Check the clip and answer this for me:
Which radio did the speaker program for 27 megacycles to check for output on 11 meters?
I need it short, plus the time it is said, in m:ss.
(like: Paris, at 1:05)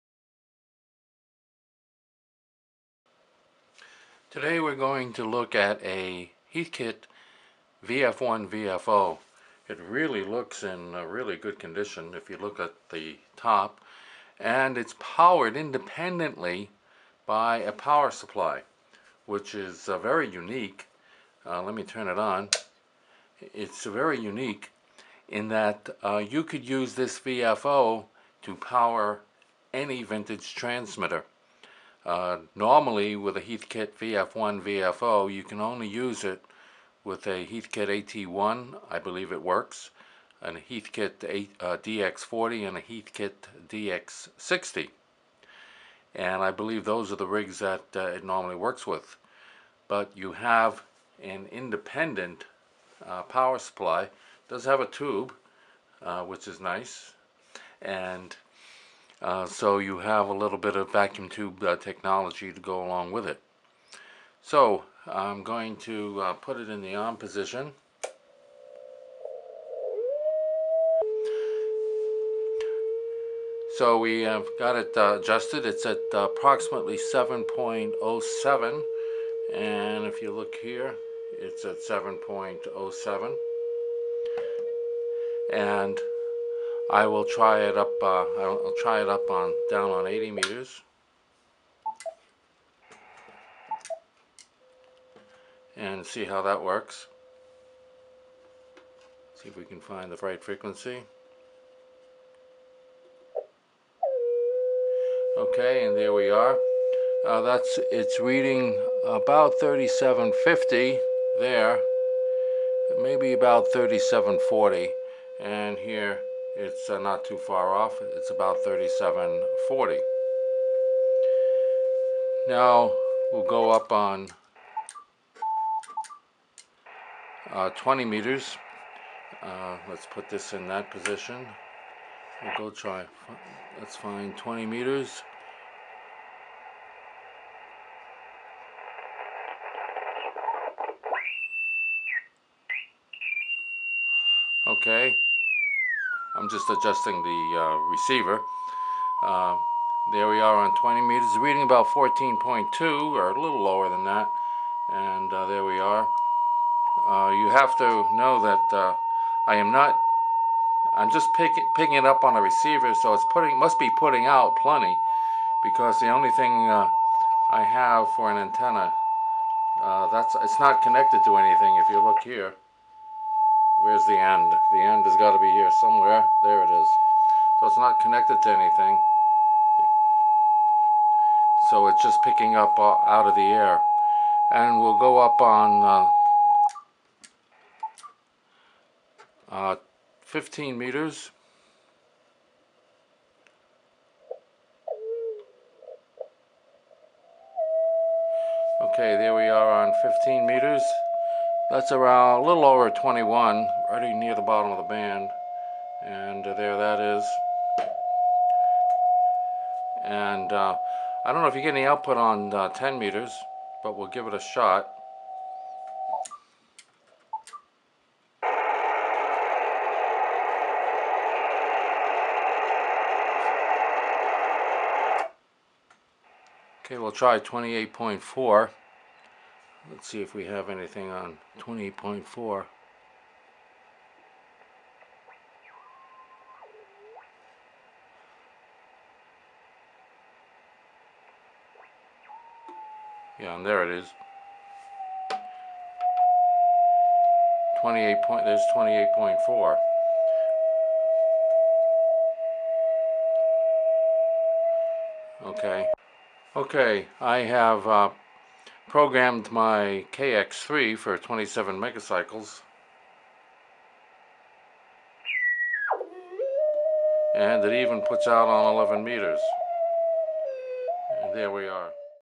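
KX3, at 4:20.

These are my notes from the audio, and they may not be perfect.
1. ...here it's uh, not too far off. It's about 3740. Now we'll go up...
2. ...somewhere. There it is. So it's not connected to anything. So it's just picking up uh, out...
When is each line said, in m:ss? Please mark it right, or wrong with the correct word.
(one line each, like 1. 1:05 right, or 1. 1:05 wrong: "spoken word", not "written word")
1. 1:55 right
2. 2:55 right.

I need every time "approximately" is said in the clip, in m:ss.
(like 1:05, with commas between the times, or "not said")
1:16.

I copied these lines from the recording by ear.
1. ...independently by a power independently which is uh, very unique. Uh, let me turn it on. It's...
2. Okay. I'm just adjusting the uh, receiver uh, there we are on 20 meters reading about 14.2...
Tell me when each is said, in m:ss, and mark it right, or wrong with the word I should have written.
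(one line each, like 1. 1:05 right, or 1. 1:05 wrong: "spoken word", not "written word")
1. 0:15 wrong: "supply", not "independently"
2. 2:24 right.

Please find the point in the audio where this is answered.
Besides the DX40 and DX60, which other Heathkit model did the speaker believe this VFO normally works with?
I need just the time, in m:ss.
0:37.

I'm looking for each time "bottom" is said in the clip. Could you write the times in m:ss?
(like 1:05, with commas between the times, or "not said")
3:24.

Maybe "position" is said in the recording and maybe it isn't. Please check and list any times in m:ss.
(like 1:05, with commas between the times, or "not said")
1:07, 2:10.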